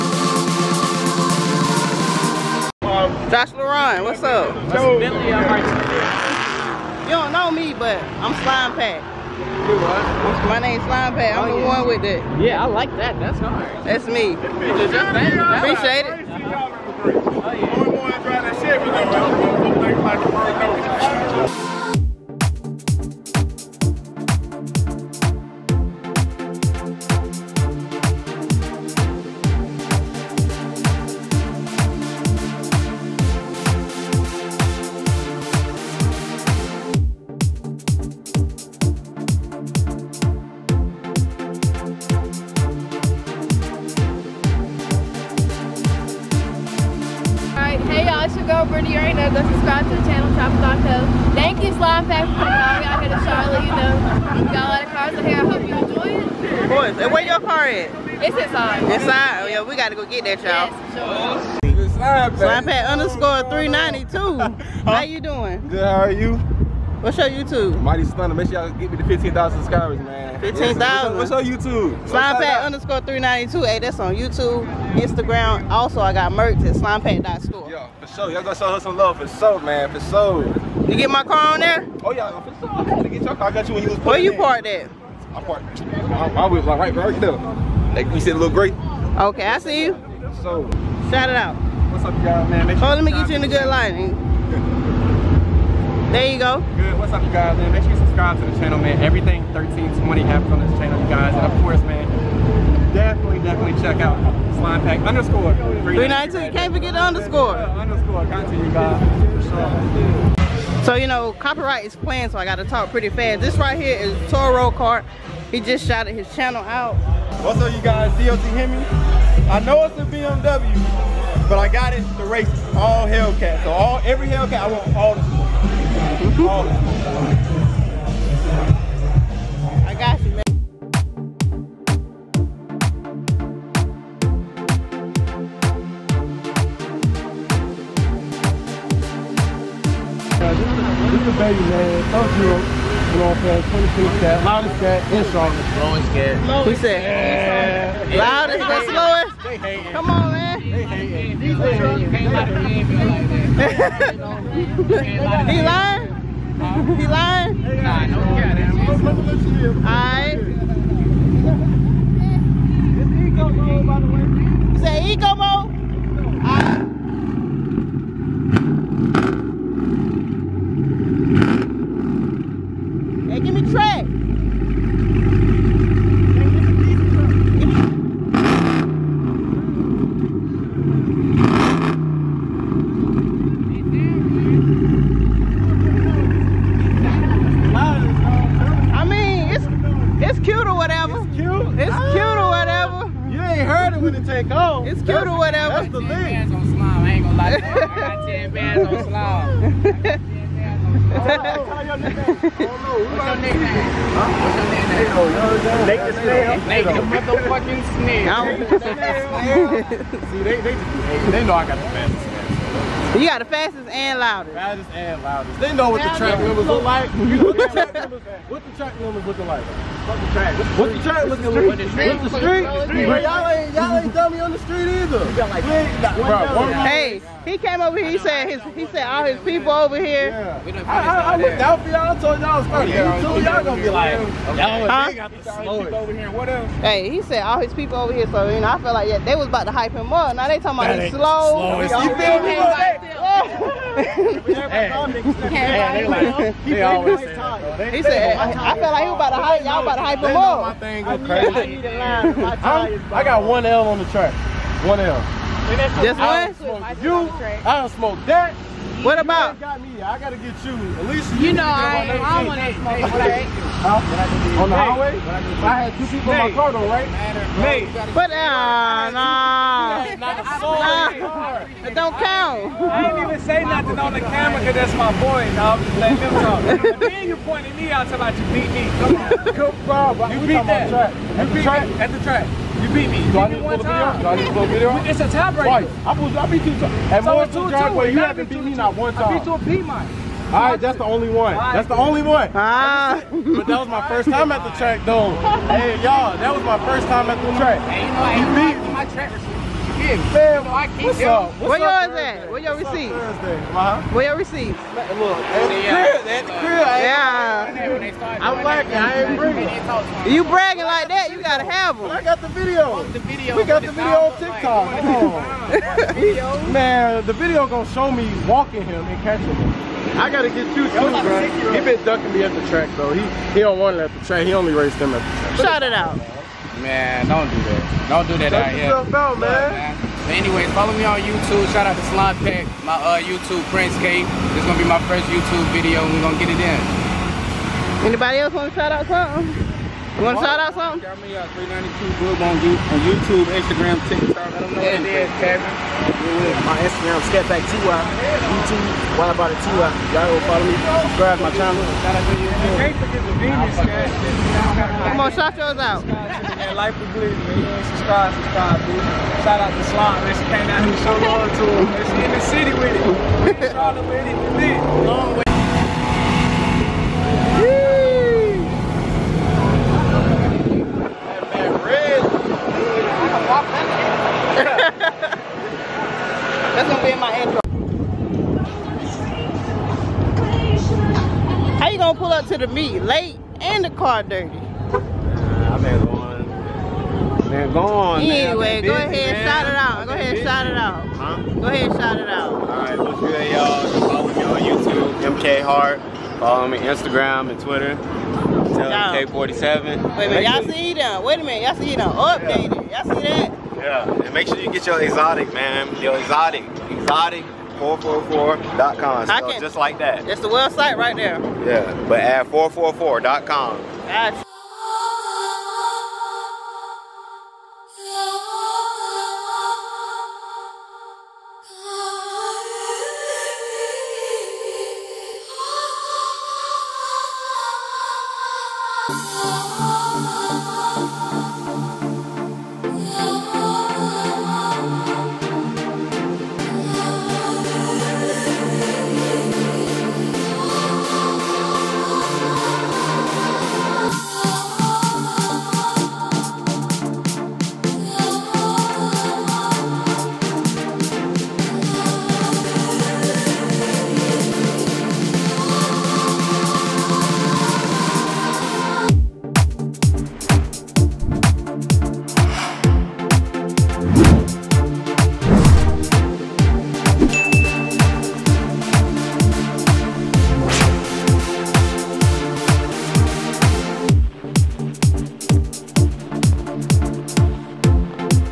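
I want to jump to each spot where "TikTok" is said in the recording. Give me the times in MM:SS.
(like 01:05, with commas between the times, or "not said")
05:14, 05:44.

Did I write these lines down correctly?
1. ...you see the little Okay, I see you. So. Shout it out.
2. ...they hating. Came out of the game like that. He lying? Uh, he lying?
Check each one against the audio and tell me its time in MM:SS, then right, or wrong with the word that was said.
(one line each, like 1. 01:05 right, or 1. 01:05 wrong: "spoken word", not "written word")
1. 01:28 right
2. 02:31 right.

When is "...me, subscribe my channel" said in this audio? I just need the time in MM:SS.
05:50.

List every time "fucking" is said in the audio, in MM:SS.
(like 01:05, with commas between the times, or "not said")
03:52.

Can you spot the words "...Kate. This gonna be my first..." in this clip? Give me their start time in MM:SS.
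05:33.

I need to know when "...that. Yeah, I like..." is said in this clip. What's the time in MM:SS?
00:12.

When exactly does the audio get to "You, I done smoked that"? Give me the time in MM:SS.
04:17.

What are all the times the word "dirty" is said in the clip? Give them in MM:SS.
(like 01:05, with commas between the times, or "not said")
06:24.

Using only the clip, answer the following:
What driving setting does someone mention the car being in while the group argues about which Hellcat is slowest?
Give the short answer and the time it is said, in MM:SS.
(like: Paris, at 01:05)
Ego mode, at 02:43.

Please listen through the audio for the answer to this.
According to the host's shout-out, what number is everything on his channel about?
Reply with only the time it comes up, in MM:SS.
01:39.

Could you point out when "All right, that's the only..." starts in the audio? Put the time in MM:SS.
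04:50.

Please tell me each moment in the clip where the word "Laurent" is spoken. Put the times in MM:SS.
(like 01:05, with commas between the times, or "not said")
00:03.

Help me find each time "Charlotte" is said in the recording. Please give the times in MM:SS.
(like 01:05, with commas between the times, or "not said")
02:25, 06:03.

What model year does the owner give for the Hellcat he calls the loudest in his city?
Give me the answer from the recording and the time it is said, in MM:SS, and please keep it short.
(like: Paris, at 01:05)
2020, at 02:23.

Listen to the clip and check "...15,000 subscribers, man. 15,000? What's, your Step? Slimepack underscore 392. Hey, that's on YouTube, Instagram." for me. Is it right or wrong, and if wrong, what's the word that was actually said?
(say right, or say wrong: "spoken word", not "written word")
wrong: "YouTube", not "Step".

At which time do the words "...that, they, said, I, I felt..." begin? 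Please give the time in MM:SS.
04:07.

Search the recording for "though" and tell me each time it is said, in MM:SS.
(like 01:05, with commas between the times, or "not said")
04:26, 04:55, 05:22.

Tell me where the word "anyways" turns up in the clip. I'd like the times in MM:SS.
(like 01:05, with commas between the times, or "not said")
05:30, 06:28.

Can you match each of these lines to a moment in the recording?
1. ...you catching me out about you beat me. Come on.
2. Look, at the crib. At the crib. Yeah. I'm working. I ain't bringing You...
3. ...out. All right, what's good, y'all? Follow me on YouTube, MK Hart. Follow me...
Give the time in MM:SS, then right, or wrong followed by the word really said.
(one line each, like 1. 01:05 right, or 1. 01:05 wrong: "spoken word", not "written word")
1. 04:37 wrong: "pointing", not "catching"
2. 05:04 right
3. 06:32 right.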